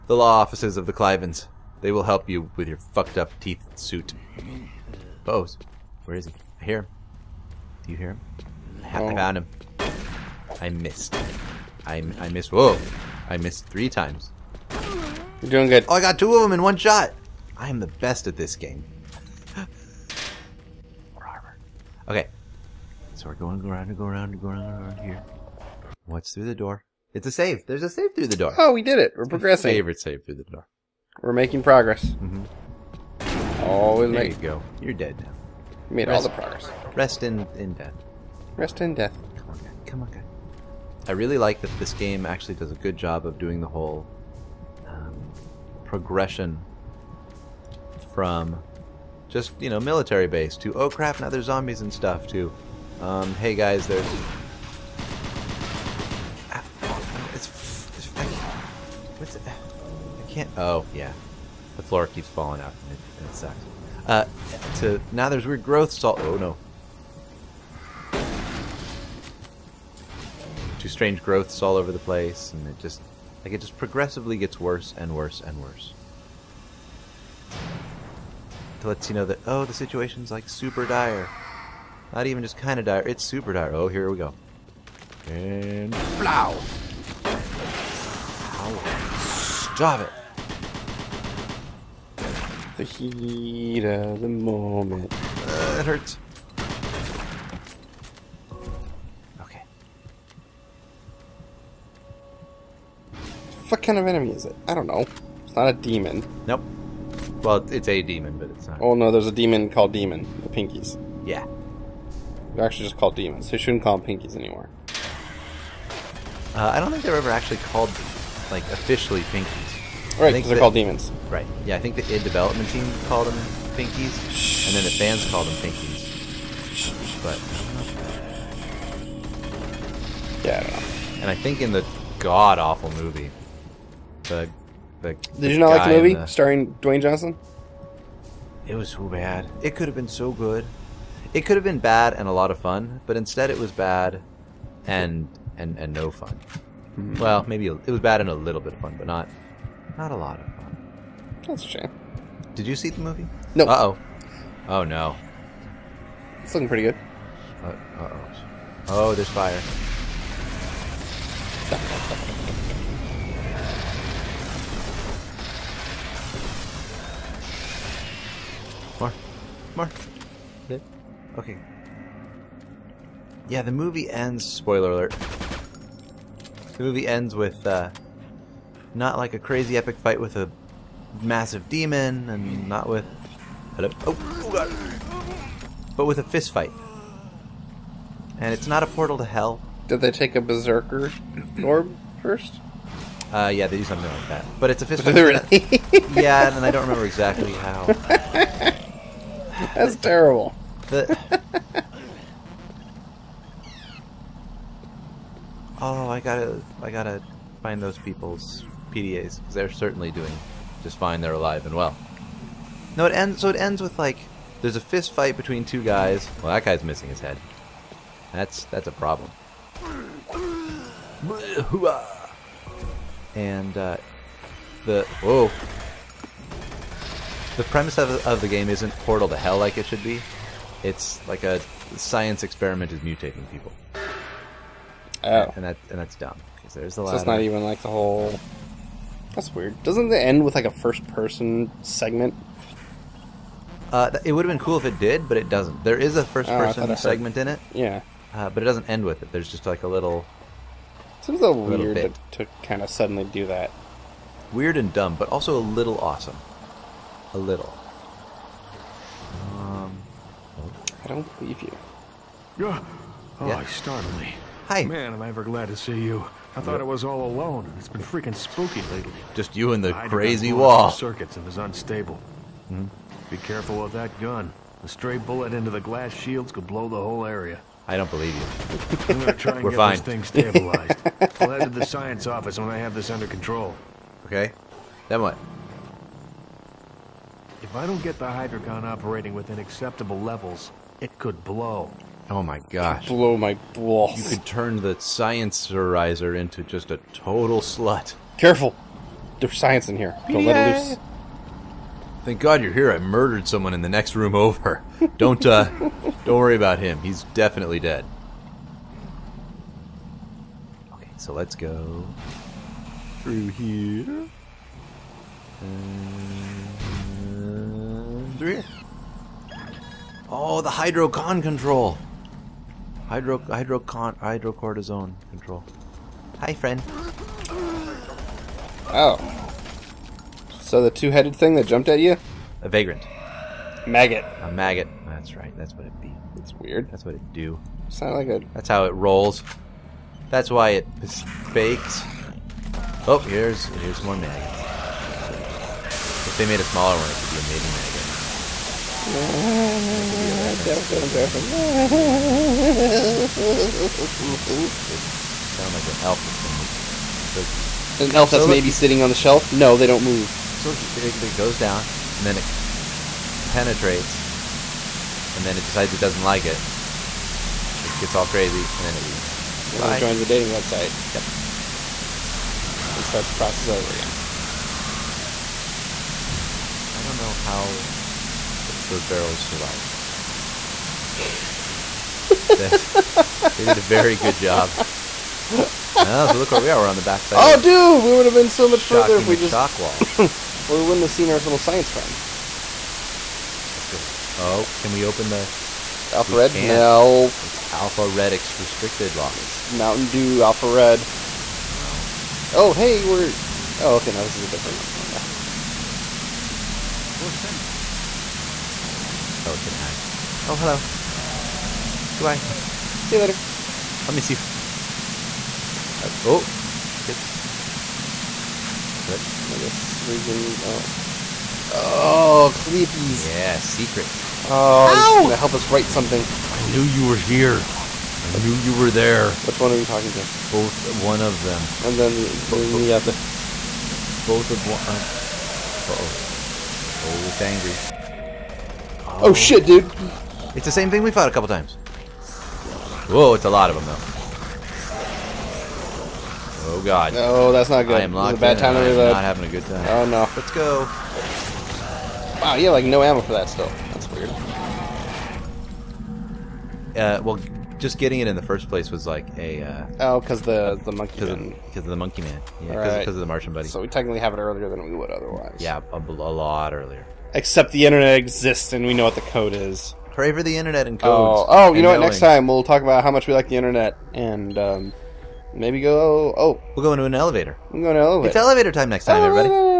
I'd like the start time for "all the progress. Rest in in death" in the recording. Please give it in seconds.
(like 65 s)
36 s.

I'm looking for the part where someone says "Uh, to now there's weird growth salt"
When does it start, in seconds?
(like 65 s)
64 s.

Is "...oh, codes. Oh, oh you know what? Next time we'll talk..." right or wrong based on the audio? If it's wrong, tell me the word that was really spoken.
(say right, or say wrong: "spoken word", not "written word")
right.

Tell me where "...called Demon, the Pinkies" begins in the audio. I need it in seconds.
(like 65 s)
109 s.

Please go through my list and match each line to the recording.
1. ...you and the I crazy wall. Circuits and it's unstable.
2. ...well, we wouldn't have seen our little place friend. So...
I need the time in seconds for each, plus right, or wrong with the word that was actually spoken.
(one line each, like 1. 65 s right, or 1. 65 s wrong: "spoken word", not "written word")
1. 269 s right
2. 390 s wrong: "science", not "place".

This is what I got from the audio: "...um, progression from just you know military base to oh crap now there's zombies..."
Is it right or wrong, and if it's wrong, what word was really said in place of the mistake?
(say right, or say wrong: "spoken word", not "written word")
right.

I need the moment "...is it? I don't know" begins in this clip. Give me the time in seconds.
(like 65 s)
104 s.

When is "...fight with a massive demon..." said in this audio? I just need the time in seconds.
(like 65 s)
179 s.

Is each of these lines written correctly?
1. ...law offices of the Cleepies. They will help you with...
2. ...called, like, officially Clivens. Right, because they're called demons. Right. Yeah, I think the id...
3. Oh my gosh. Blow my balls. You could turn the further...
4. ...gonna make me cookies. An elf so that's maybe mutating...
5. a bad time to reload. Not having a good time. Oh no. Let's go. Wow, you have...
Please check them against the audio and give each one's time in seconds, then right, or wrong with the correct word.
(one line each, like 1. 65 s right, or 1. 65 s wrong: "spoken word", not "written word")
1. 0 s wrong: "Clivens", not "Cleepies"
2. 117 s wrong: "Pinkies", not "Clivens"
3. 292 s wrong: "sciencerizer", not "further"
4. 356 s wrong: "sitting", not "mutating"
5. 448 s right.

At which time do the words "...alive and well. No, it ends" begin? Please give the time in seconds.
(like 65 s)
211 s.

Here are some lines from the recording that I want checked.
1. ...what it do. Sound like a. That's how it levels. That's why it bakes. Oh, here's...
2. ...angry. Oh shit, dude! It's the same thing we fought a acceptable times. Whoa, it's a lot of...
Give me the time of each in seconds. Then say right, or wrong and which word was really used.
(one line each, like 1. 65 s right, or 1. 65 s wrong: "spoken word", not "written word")
1. 337 s wrong: "rolls", not "levels"
2. 437 s wrong: "couple", not "acceptable".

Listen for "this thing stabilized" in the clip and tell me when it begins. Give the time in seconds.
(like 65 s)
279 s.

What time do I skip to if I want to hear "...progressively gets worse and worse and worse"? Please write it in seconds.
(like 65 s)
73 s.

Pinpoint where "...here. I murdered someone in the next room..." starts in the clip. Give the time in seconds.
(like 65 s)
302 s.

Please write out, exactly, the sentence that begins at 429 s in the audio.
Which one are you talking to?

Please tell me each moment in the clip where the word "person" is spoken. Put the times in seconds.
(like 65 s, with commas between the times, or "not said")
241 s, 246 s.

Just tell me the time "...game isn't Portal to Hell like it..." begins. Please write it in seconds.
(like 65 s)
228 s.